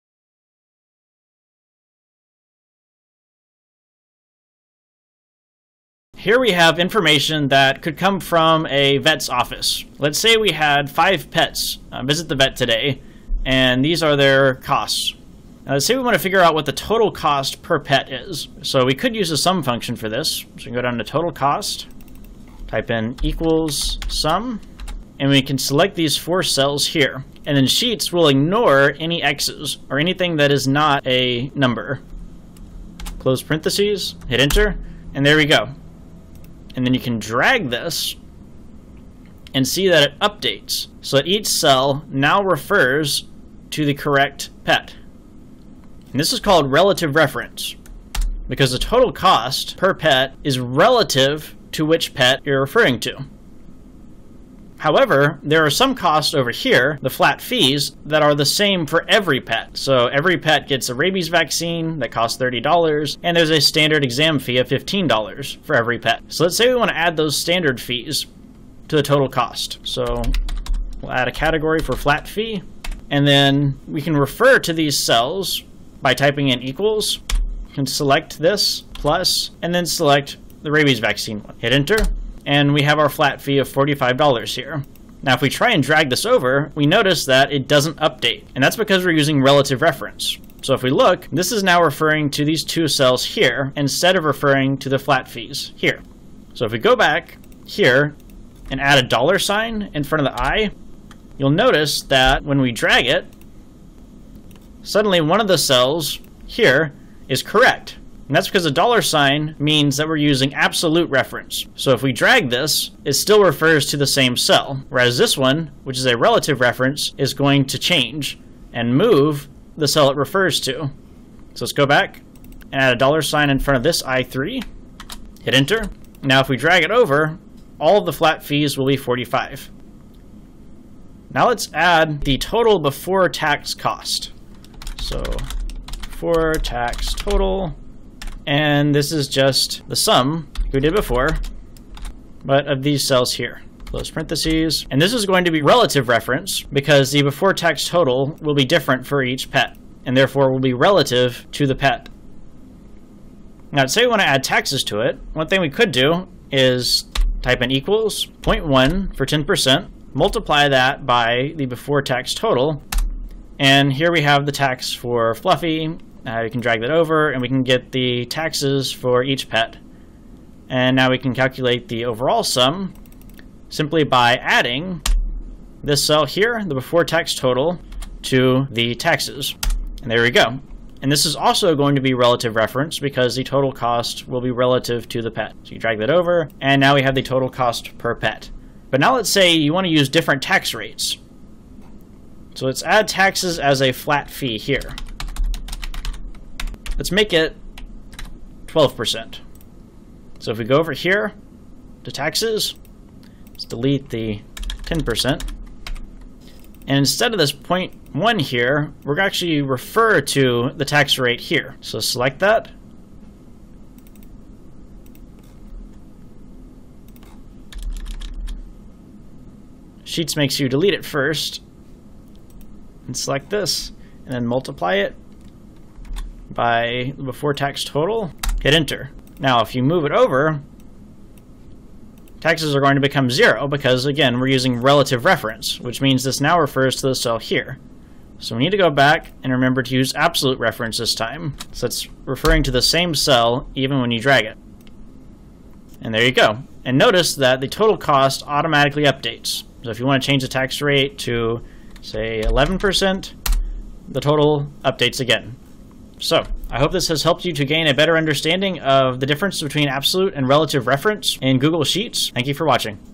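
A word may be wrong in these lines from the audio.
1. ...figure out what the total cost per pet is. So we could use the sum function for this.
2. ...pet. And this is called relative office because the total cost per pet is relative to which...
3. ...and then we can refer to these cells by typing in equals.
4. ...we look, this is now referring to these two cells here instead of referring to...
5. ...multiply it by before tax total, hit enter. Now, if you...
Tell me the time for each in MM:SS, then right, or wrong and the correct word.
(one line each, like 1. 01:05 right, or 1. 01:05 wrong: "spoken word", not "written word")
1. 00:16 right
2. 00:44 wrong: "reference", not "office"
3. 01:13 right
4. 01:30 right
5. 03:44 right.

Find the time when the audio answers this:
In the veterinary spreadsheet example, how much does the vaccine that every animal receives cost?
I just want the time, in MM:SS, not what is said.
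01:02.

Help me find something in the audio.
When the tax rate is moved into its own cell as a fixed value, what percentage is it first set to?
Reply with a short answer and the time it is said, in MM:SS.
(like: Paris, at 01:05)
12%, at 03:18.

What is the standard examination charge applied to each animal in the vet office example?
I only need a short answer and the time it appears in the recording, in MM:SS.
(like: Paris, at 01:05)
$15, at 01:04.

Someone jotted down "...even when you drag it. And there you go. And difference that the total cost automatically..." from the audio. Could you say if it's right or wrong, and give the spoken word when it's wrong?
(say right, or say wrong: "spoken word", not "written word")
wrong: "notice", not "difference".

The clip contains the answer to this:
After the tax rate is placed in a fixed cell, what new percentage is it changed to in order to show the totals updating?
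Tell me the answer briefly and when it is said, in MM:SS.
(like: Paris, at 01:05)
11%, at 04:12.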